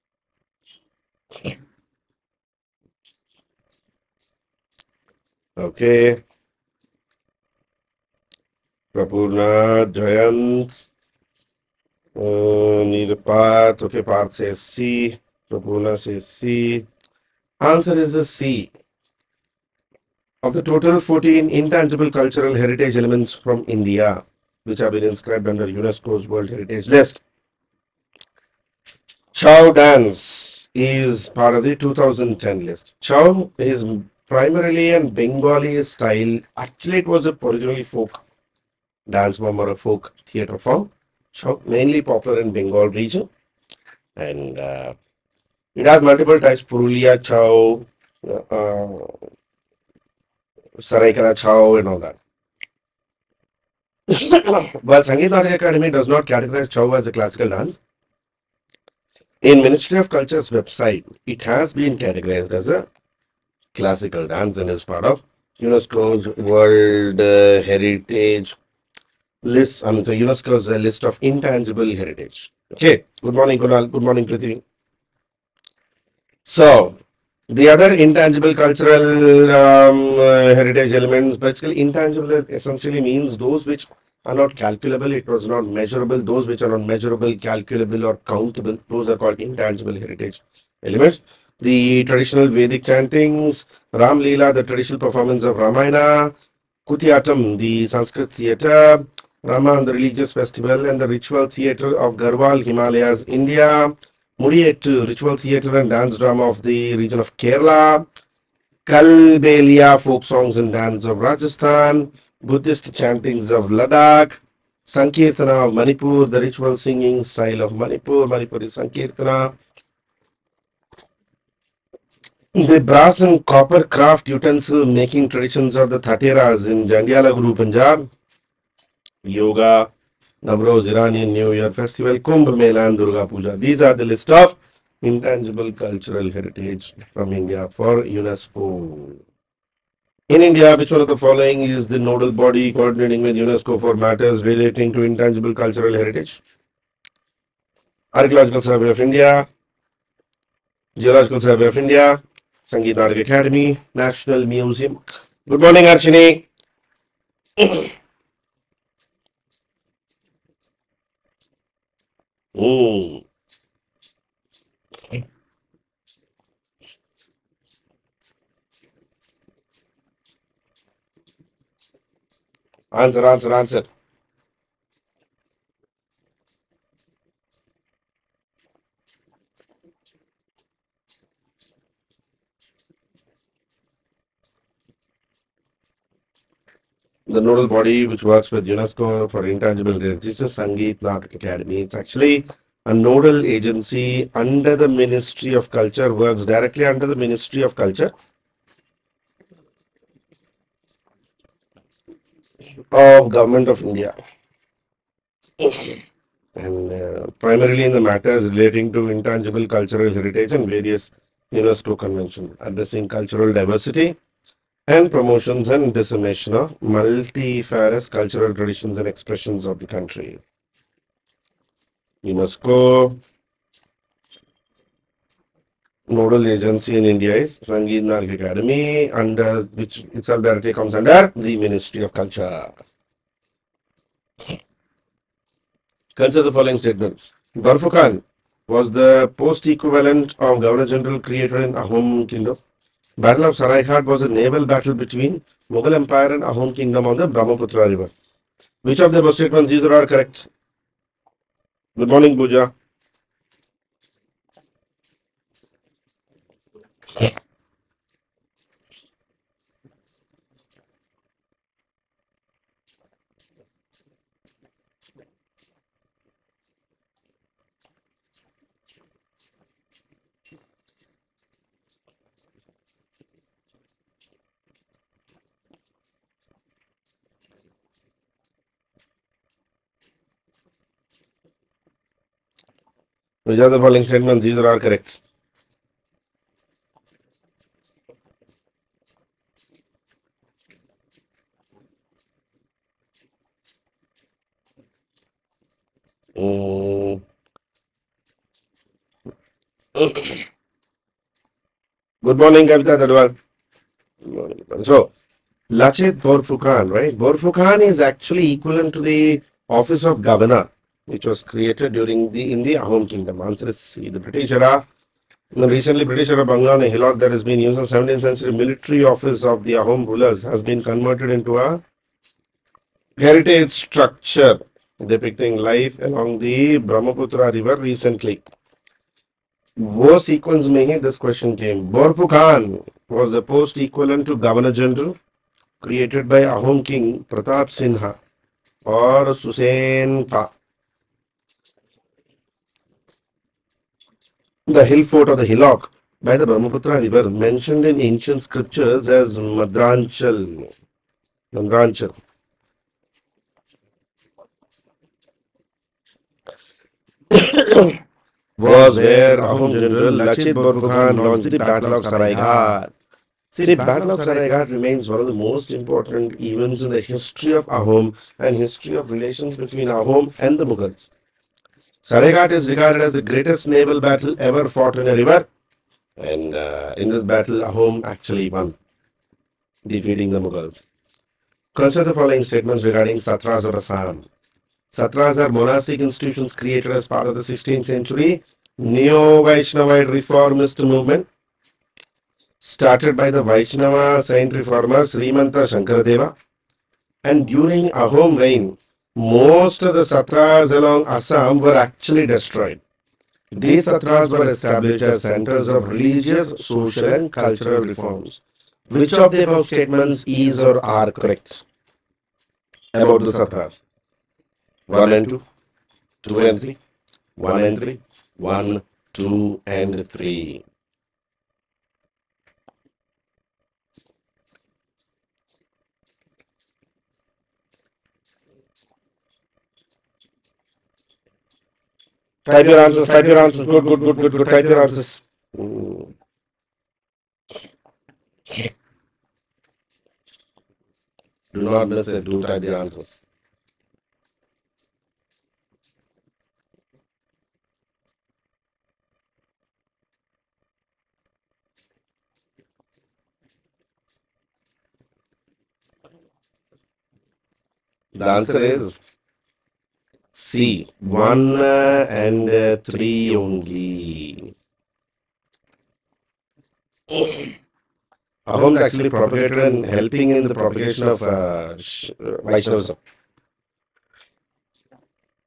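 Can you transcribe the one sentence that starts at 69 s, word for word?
I mean, so UNESCO's uh, list of intangible heritage.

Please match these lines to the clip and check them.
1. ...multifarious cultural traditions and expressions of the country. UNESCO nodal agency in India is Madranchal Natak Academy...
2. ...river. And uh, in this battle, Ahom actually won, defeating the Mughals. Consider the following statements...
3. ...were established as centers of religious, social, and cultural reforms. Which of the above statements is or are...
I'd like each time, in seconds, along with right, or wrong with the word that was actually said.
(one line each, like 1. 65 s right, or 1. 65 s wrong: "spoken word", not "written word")
1. 216 s wrong: "Sangeet", not "Madranchal"
2. 375 s right
3. 404 s right.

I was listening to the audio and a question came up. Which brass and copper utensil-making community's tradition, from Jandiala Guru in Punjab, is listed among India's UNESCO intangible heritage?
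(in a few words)
Thateras.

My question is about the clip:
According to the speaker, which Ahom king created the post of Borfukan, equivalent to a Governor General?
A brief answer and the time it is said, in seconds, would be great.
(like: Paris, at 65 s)
Pratap Sinha, at 337 s.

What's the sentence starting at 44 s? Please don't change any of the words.
And uh, it has multiple types: purulia, chow, uh, uh, Seraikela chow, and all that.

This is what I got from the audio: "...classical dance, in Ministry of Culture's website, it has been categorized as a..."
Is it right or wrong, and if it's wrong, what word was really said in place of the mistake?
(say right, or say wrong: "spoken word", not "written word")
right.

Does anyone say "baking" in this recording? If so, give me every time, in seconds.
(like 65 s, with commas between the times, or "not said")
not said.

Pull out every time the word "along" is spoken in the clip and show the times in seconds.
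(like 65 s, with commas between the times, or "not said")
326 s, 400 s.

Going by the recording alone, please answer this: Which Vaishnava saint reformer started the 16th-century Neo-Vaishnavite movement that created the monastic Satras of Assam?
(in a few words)
Srimanta Shankaradeva.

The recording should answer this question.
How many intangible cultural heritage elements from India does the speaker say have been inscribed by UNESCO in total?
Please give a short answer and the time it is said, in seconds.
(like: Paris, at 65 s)
14, at 21 s.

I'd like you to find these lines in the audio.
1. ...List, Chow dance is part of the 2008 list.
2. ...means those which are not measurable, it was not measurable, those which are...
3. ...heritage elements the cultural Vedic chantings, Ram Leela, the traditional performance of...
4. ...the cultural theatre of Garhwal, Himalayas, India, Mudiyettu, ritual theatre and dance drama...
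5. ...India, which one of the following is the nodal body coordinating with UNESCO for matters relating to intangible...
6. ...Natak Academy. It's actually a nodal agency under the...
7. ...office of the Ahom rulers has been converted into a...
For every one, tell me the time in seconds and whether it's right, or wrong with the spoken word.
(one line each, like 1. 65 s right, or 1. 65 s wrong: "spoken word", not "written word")
1. 26 s wrong: "2010", not "2008"
2. 83 s wrong: "calculable", not "measurable"
3. 89 s wrong: "traditional", not "cultural"
4. 101 s wrong: "ritual", not "cultural"
5. 140 s right
6. 191 s right
7. 319 s right.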